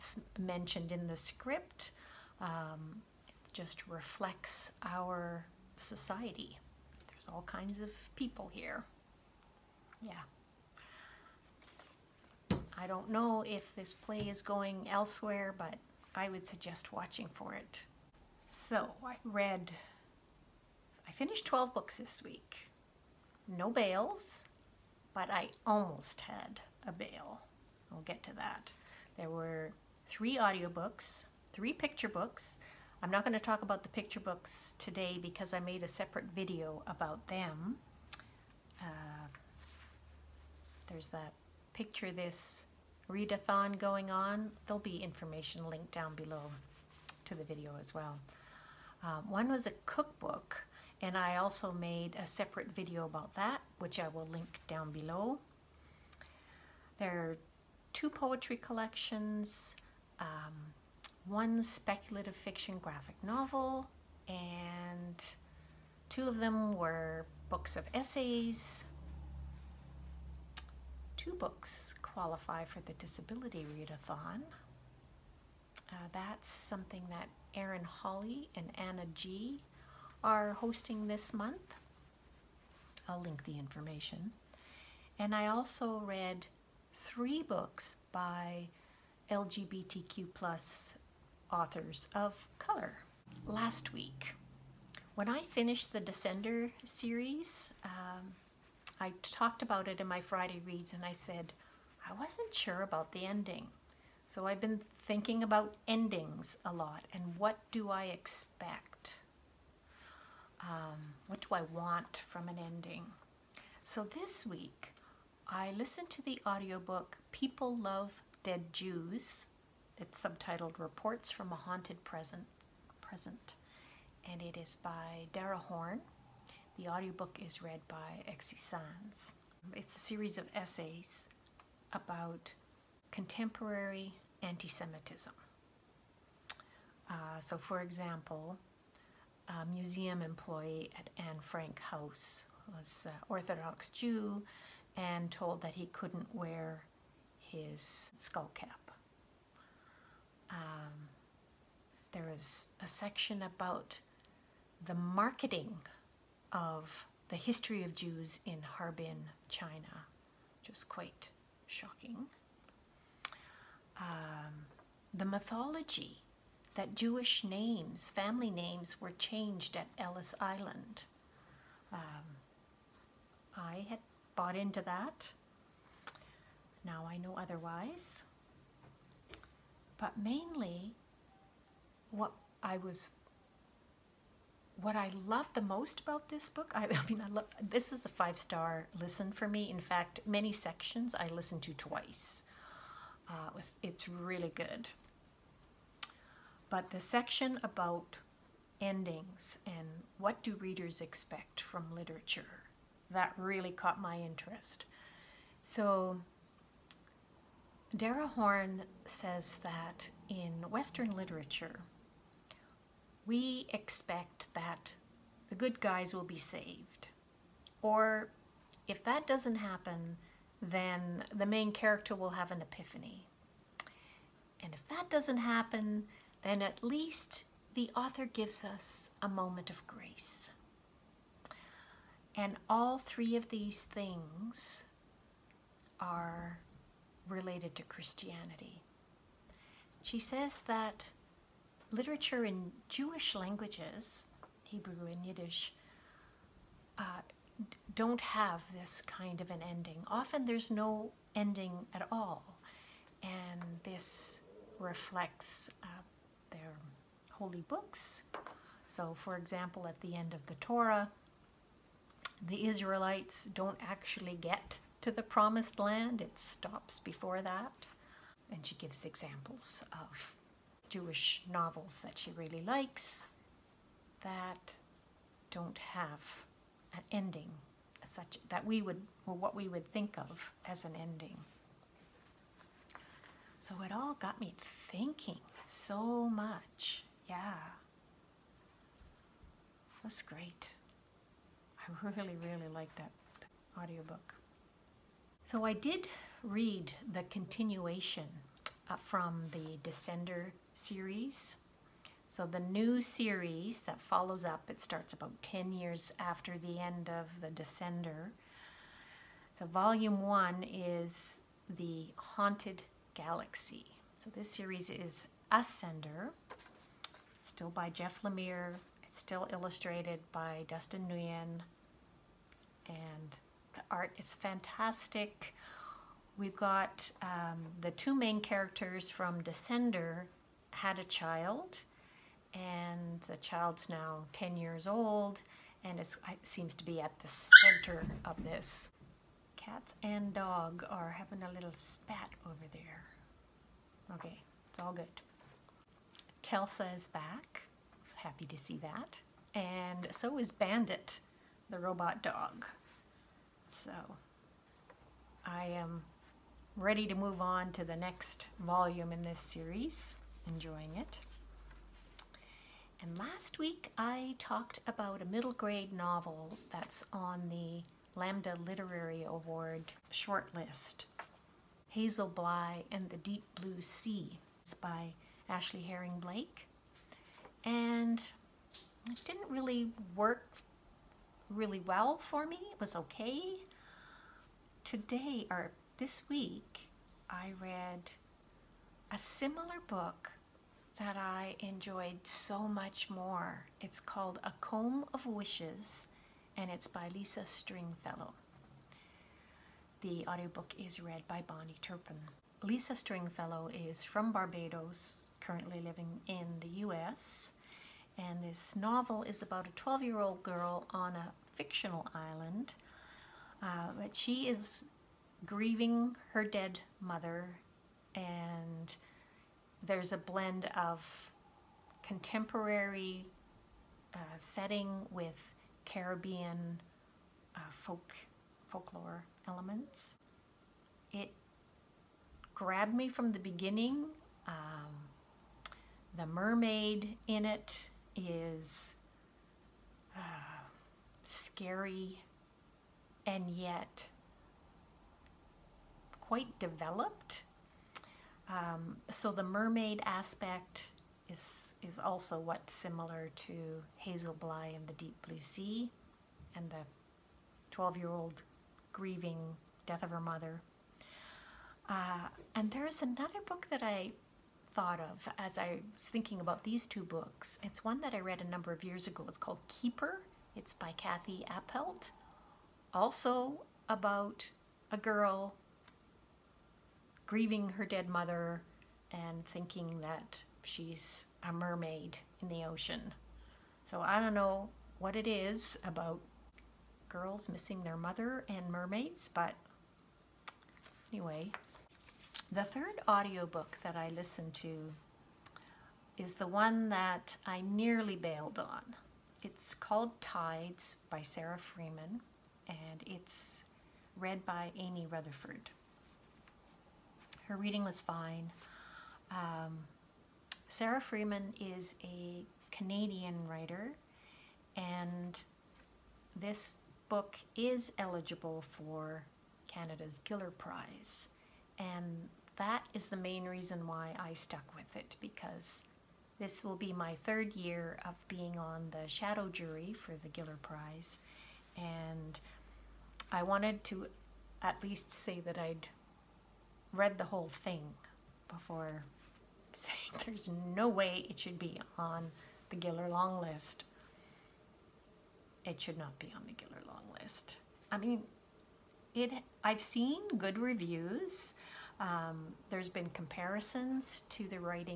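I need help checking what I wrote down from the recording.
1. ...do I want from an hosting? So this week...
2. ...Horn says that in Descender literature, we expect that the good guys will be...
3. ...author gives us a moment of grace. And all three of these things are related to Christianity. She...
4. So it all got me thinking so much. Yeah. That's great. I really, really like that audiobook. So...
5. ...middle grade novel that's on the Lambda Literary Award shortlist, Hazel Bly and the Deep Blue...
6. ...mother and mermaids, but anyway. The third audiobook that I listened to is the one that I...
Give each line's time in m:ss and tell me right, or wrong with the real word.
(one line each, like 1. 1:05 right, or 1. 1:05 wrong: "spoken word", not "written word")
1. 1:51 wrong: "ending", not "hosting"
2. 3:28 wrong: "Western", not "Descender"
3. 3:47 right
4. 4:43 right
5. 6:05 right
6. 8:07 right.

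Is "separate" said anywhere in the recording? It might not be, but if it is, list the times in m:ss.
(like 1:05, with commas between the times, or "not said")
0:35, 0:52.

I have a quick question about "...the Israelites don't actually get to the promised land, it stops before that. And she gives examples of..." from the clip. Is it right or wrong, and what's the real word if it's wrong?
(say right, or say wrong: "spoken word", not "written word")
right.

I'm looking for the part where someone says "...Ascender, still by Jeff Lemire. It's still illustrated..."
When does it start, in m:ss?
5:15.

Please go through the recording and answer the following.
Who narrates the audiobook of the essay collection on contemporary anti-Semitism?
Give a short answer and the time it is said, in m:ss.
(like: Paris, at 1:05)
Exie Sanz, at 2:08.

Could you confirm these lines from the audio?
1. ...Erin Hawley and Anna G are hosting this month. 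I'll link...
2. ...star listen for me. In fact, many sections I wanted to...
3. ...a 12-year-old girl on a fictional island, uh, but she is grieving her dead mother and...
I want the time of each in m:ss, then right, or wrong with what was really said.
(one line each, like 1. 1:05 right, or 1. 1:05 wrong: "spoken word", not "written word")
1. 1:17 right
2. 3:08 wrong: "listened", not "wanted"
3. 6:49 right.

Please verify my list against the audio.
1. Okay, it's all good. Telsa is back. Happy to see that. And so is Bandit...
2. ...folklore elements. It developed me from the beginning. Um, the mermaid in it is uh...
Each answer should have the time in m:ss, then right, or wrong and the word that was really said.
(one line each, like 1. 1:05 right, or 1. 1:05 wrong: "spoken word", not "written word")
1. 5:44 right
2. 7:08 wrong: "grabbed", not "developed".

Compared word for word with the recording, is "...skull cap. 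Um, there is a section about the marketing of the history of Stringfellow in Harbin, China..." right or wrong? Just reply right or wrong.
wrong.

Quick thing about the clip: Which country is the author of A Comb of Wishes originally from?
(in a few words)
Barbados.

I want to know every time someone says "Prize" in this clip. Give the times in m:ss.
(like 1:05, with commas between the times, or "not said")
8:40, 8:50.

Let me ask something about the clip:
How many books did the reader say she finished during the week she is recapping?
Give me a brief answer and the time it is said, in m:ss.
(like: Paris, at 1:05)
12, at 0:21.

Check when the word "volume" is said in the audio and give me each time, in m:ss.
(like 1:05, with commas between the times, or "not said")
5:09, 5:58.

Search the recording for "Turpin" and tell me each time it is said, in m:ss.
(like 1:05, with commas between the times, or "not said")
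6:41.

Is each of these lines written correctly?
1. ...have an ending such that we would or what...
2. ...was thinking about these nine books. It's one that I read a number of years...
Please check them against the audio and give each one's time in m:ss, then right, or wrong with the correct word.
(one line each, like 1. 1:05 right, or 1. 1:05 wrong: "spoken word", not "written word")
1. 4:35 right
2. 7:45 wrong: "two", not "nine".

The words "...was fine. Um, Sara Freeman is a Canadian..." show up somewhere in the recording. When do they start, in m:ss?
8:27.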